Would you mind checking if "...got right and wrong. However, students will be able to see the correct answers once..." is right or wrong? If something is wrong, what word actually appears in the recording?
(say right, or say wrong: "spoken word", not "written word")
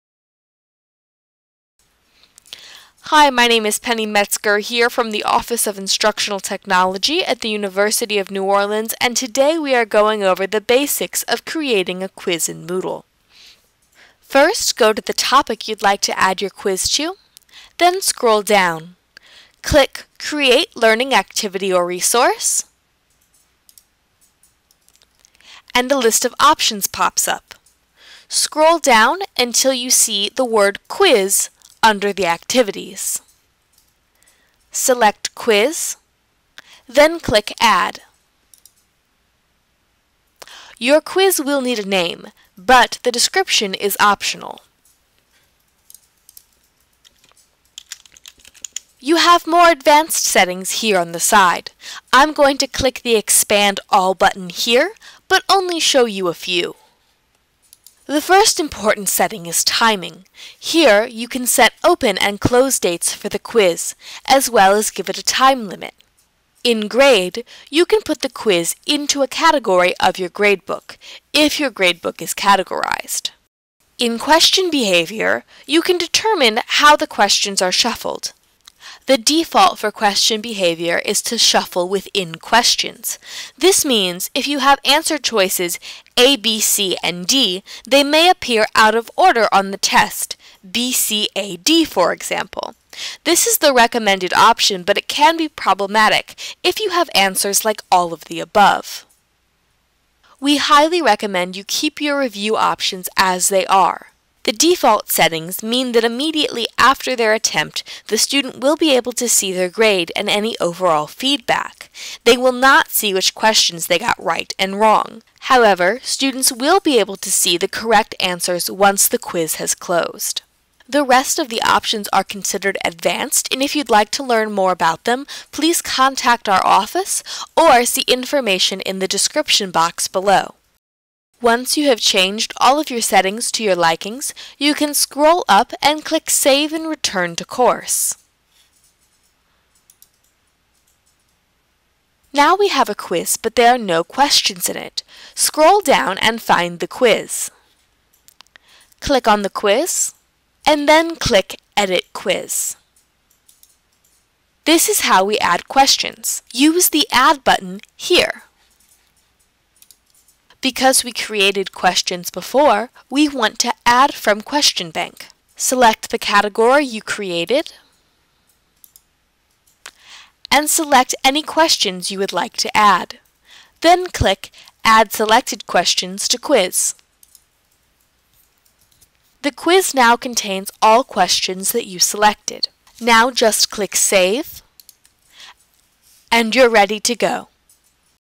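right.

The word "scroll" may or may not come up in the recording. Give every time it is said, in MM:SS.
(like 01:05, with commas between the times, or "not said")
00:18, 00:28, 02:14, 02:25.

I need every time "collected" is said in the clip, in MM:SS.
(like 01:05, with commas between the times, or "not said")
not said.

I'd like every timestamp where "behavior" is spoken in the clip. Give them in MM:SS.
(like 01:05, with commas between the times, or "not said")
01:14, 01:20.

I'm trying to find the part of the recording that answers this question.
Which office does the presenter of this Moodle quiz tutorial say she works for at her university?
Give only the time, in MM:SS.
00:05.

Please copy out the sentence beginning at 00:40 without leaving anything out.
Your quiz will need a name, but the description is optional.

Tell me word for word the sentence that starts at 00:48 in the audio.
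You have more advanced settings here on the side.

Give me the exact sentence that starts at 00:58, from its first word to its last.
The first important setting is timing.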